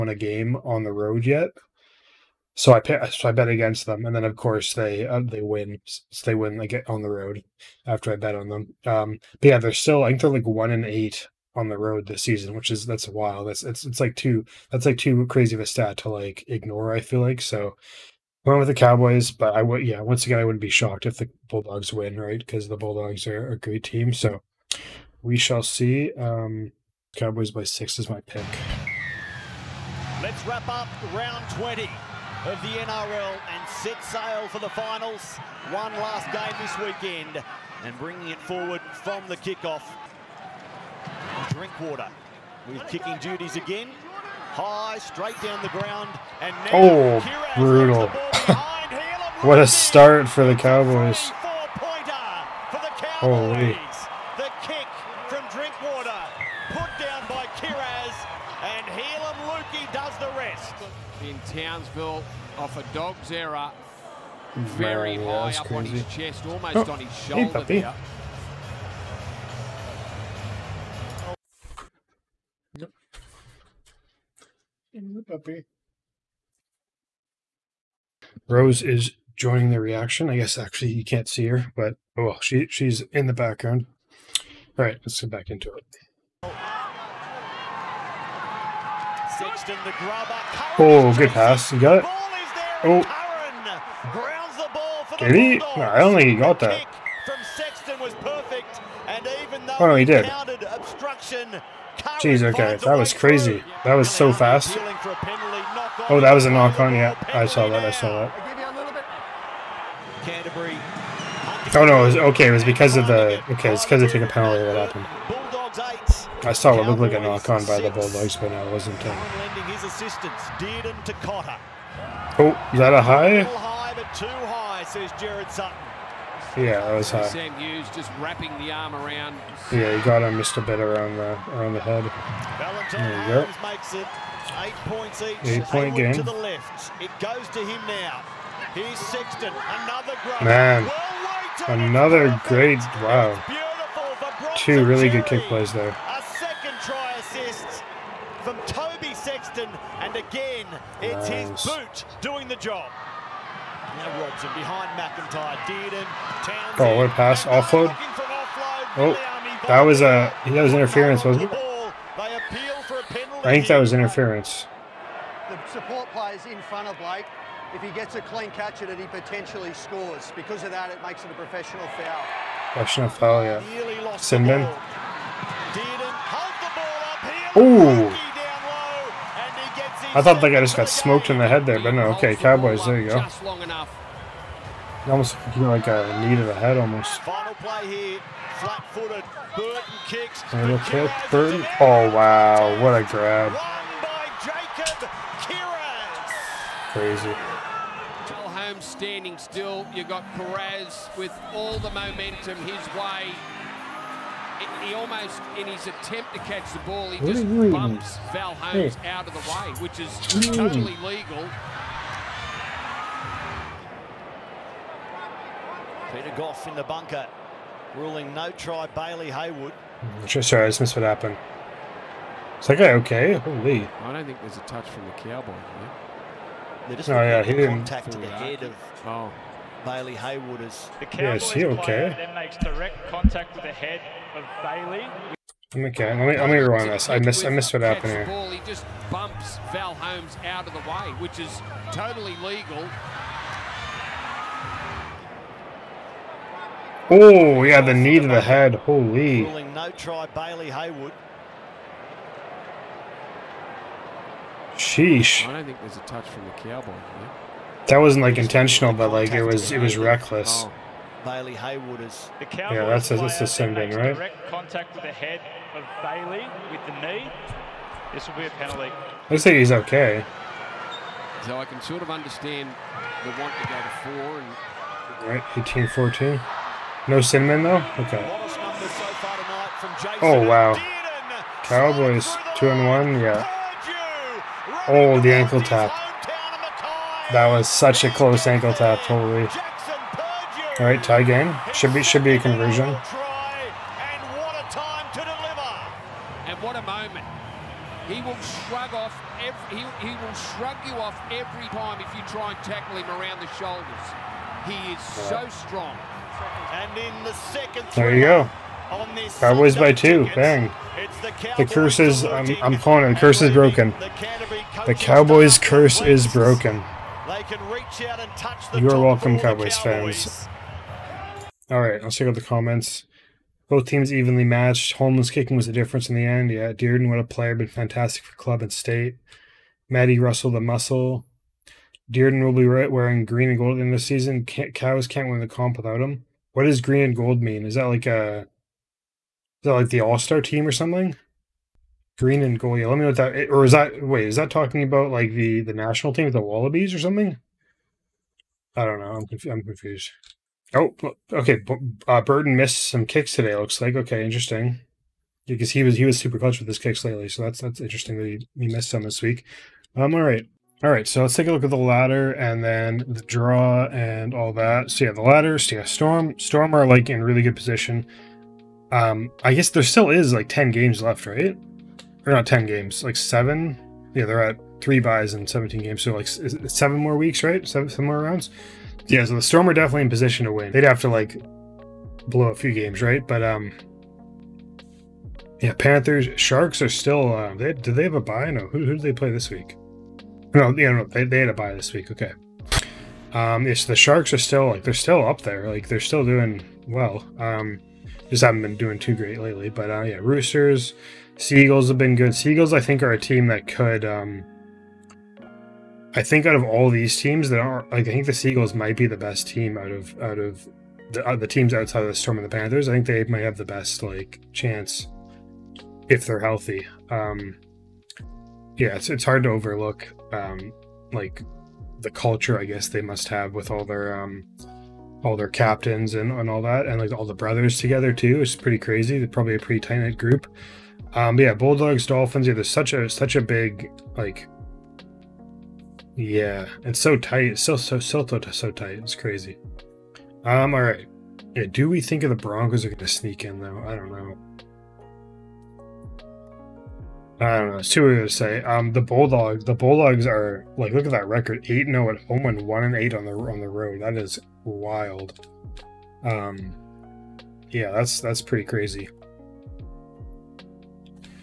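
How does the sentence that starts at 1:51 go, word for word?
Oh no, it was, okay, it was because of the okay, it's because they took a penalty that happened.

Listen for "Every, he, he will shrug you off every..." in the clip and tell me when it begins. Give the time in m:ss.
4:59.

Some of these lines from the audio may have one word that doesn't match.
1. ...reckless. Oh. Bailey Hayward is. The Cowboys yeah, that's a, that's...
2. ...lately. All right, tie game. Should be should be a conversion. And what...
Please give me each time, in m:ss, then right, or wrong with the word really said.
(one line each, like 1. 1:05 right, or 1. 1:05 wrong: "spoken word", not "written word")
1. 4:19 right
2. 4:49 wrong: "totally", not "lately".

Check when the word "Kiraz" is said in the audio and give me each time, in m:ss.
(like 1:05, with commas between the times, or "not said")
0:57.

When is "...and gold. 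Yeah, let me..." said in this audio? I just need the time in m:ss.
5:42.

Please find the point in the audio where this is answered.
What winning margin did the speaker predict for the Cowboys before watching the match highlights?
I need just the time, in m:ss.
0:27.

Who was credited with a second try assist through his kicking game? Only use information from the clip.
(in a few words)
Toby Sexton.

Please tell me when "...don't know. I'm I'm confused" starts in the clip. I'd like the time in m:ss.
5:48.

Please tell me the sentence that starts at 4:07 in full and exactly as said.
Oh yeah, the knee to the head.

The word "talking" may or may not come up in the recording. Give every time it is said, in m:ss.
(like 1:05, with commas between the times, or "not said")
5:44.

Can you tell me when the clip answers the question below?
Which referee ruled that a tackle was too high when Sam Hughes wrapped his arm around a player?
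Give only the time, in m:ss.
2:05.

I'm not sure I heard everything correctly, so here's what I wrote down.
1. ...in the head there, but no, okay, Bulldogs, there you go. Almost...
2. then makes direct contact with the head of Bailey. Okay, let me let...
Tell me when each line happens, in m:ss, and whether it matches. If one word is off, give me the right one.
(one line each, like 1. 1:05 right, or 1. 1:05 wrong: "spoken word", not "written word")
1. 3:01 wrong: "Cowboys", not "Bulldogs"
2. 3:52 right.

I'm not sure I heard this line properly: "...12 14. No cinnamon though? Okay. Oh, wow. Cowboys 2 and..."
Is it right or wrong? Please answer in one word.
wrong.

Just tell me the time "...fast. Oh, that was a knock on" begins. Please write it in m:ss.
1:44.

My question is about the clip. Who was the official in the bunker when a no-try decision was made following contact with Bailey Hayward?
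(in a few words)
Peter Gough.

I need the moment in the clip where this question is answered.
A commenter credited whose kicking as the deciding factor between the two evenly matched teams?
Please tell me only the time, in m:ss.
5:24.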